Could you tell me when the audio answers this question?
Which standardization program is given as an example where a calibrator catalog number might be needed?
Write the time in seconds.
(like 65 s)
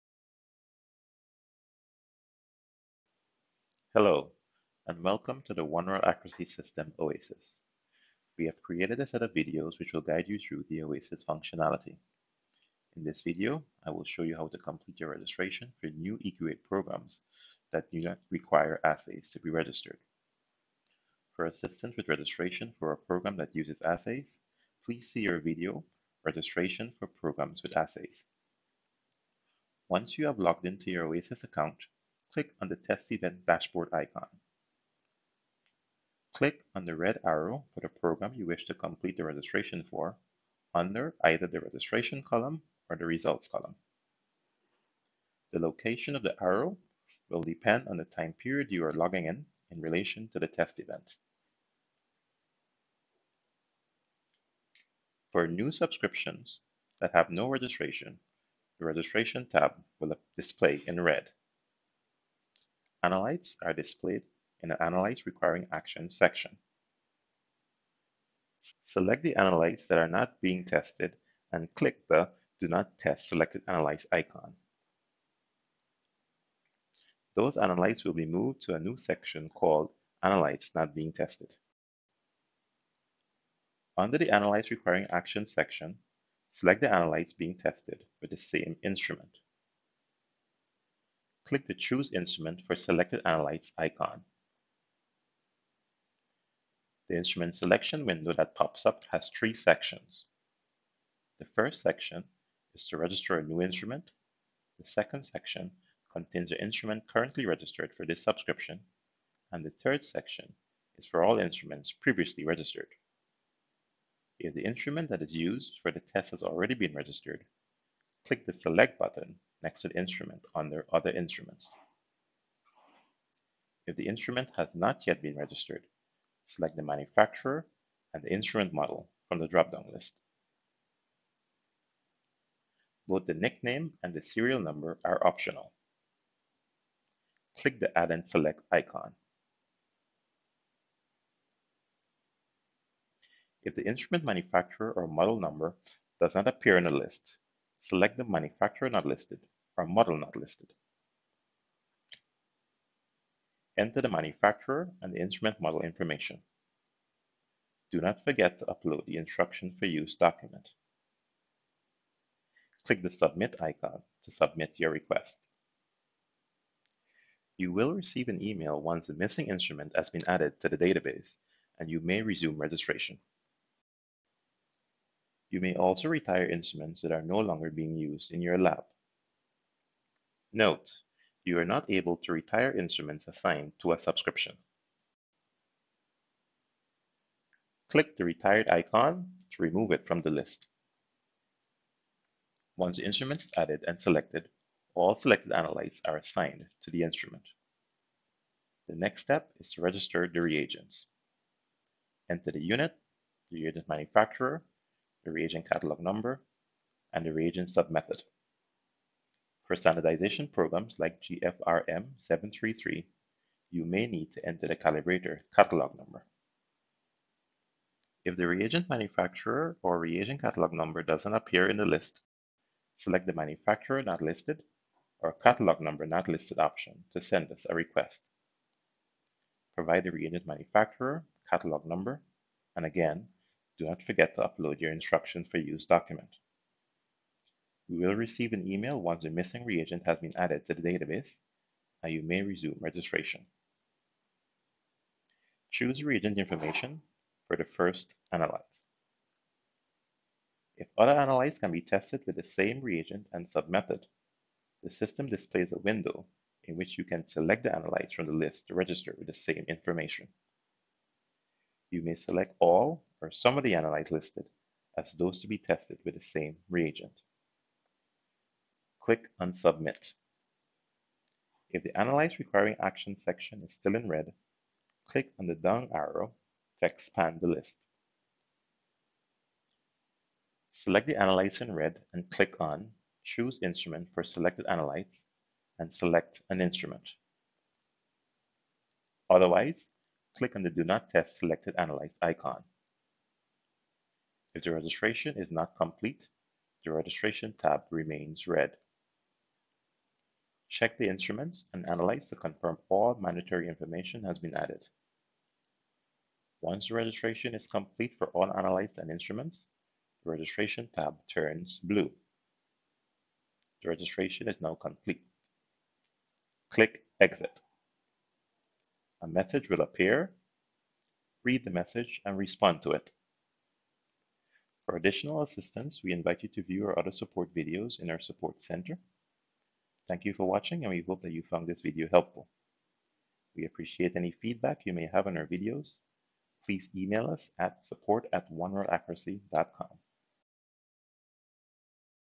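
211 s.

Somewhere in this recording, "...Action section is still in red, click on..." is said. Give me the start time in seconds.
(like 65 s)
272 s.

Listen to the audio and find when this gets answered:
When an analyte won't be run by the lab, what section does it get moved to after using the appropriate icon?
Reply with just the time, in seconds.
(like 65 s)
80 s.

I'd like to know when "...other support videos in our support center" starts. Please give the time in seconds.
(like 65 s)
326 s.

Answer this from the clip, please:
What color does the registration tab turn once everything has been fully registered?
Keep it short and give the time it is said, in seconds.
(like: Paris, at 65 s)
blue, at 311 s.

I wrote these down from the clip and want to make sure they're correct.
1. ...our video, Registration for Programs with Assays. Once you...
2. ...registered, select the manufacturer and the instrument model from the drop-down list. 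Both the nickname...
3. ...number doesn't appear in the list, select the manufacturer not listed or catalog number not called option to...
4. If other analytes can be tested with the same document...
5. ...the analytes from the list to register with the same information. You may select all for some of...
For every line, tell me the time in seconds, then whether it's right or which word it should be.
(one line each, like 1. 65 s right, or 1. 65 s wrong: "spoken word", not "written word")
1. 25 s right
2. 125 s right
3. 220 s wrong: "listed", not "called"
4. 250 s wrong: "reagent", not "document"
5. 257 s right.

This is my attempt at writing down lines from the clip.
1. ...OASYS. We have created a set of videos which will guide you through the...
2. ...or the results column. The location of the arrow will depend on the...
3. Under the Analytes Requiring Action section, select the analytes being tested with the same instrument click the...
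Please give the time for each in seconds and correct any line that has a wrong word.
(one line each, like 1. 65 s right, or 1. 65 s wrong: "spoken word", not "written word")
1. 6 s right
2. 42 s right
3. 83 s right.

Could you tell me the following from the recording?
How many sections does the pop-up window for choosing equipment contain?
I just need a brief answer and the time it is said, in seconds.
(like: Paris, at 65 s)
3, at 99 s.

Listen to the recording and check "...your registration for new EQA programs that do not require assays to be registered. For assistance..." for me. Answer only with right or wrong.
right.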